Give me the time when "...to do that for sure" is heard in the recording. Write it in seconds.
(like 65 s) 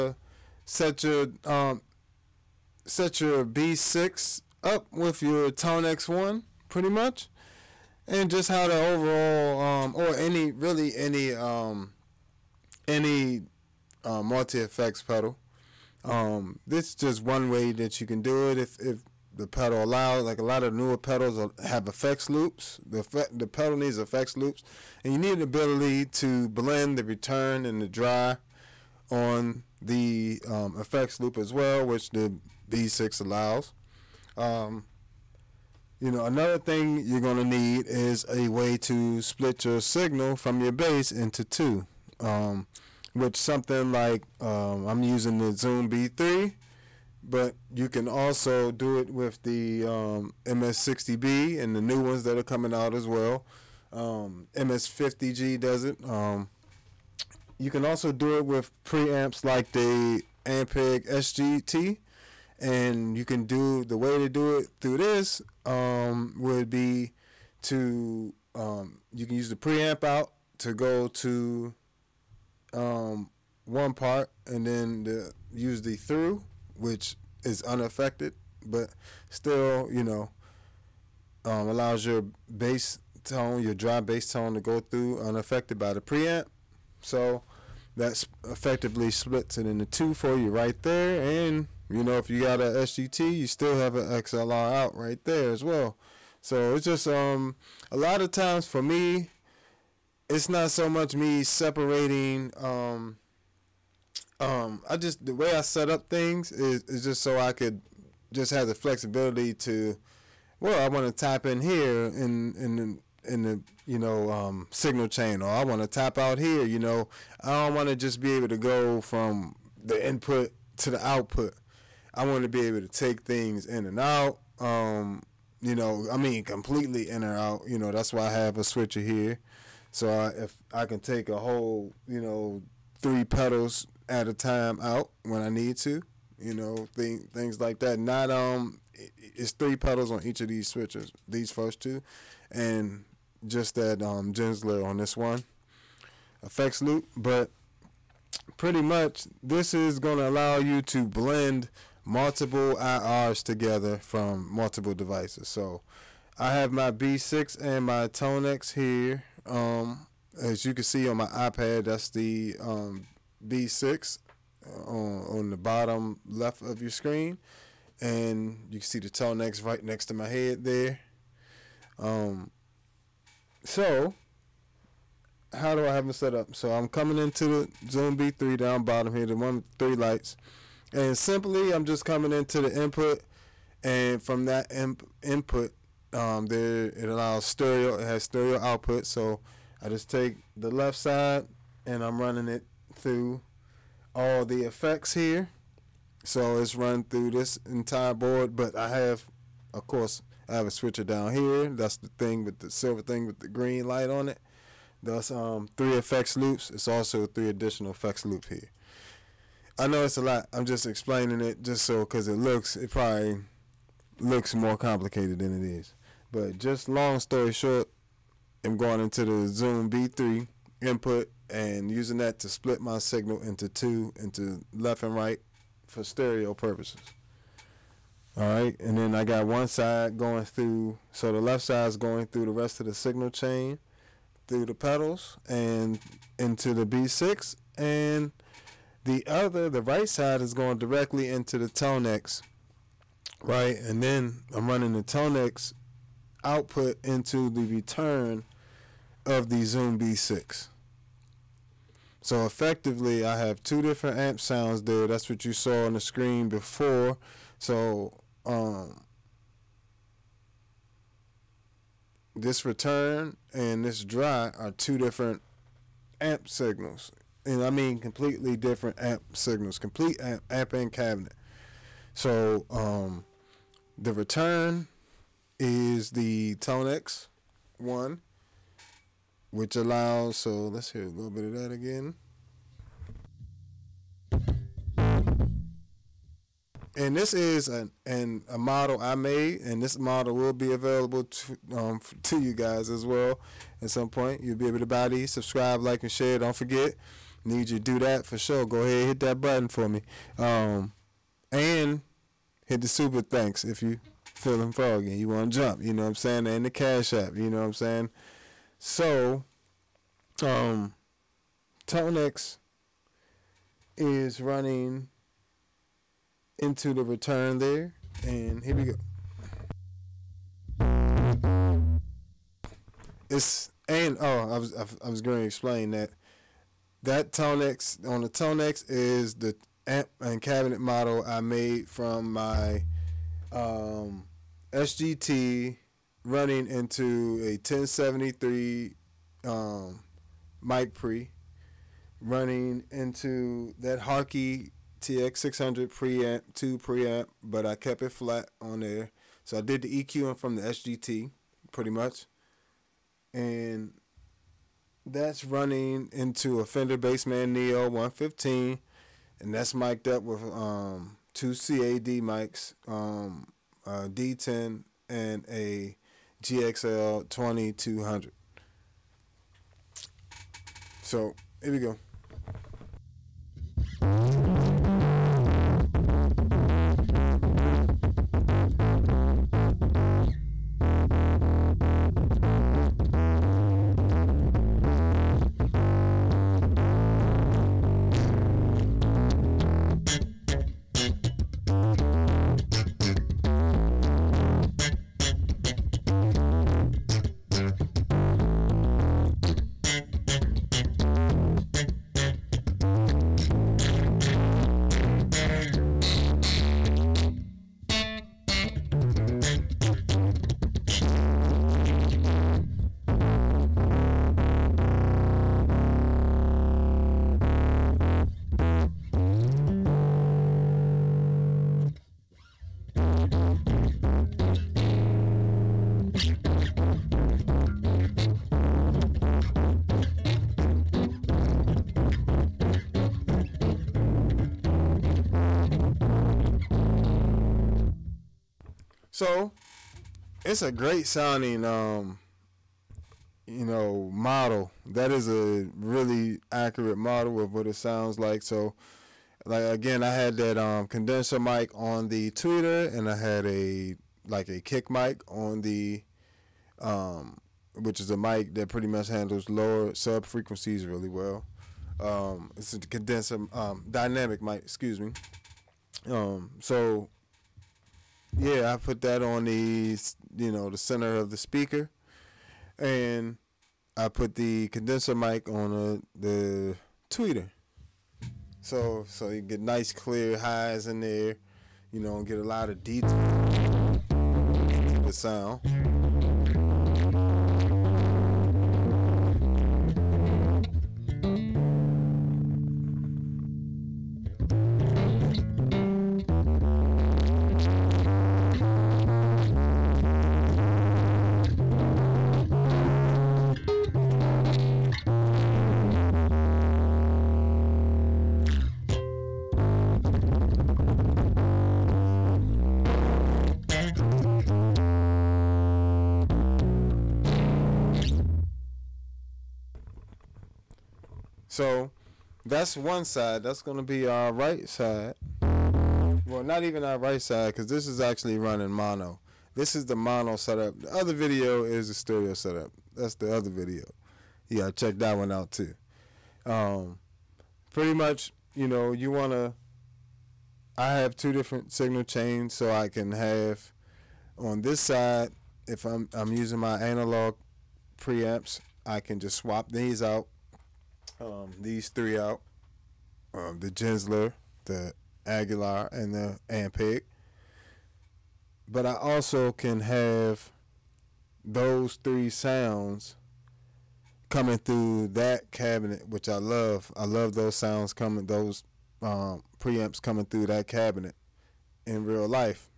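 297 s.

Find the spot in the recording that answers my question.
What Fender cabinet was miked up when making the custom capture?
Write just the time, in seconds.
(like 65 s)
356 s.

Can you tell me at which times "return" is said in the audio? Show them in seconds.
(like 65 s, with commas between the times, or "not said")
27 s, 247 s, 262 s, 274 s, 317 s.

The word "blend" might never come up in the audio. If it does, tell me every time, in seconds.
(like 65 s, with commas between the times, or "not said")
26 s, 151 s.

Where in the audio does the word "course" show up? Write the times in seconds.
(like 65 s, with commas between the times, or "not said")
199 s.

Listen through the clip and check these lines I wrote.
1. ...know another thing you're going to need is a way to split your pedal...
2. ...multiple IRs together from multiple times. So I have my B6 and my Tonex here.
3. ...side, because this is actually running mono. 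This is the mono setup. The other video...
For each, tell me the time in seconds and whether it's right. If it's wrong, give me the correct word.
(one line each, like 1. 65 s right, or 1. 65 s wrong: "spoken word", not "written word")
1. 36 s wrong: "signal", not "pedal"
2. 152 s wrong: "devices", not "times"
3. 527 s right.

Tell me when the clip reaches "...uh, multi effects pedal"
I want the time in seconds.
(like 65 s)
14 s.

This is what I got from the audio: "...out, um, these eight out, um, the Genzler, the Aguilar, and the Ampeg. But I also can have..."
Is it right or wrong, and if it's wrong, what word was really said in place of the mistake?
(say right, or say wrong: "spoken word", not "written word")
wrong: "three", not "eight".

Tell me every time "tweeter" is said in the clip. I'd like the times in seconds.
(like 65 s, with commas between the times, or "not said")
452 s, 477 s.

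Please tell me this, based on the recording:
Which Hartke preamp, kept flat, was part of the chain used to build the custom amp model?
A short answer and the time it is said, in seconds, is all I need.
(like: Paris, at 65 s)
Hartke TX600, at 344 s.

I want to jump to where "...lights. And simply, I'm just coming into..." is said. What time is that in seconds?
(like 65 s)
179 s.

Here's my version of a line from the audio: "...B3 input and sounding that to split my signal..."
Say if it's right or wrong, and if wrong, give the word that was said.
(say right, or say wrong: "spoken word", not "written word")
wrong: "using", not "sounding".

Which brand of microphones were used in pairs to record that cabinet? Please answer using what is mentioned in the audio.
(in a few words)
CAD.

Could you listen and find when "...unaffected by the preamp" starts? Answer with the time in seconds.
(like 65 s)
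85 s.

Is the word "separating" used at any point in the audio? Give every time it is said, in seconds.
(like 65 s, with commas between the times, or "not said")
101 s.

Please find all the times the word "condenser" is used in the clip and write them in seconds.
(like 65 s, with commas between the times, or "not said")
450 s, 462 s, 474 s.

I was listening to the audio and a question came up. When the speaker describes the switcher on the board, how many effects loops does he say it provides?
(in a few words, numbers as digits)
3.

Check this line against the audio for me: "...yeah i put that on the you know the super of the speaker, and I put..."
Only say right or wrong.
wrong.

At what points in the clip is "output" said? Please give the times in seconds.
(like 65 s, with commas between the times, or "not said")
121 s, 188 s, 246 s.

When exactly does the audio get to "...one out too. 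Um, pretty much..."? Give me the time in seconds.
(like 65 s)
535 s.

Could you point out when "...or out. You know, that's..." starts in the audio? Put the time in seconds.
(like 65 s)
127 s.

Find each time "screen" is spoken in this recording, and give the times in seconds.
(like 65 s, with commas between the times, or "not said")
166 s, 255 s.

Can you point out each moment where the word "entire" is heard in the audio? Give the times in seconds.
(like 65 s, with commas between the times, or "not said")
197 s.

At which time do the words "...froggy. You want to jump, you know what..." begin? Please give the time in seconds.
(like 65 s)
304 s.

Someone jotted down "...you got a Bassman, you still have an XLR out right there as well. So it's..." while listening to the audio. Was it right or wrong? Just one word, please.
wrong.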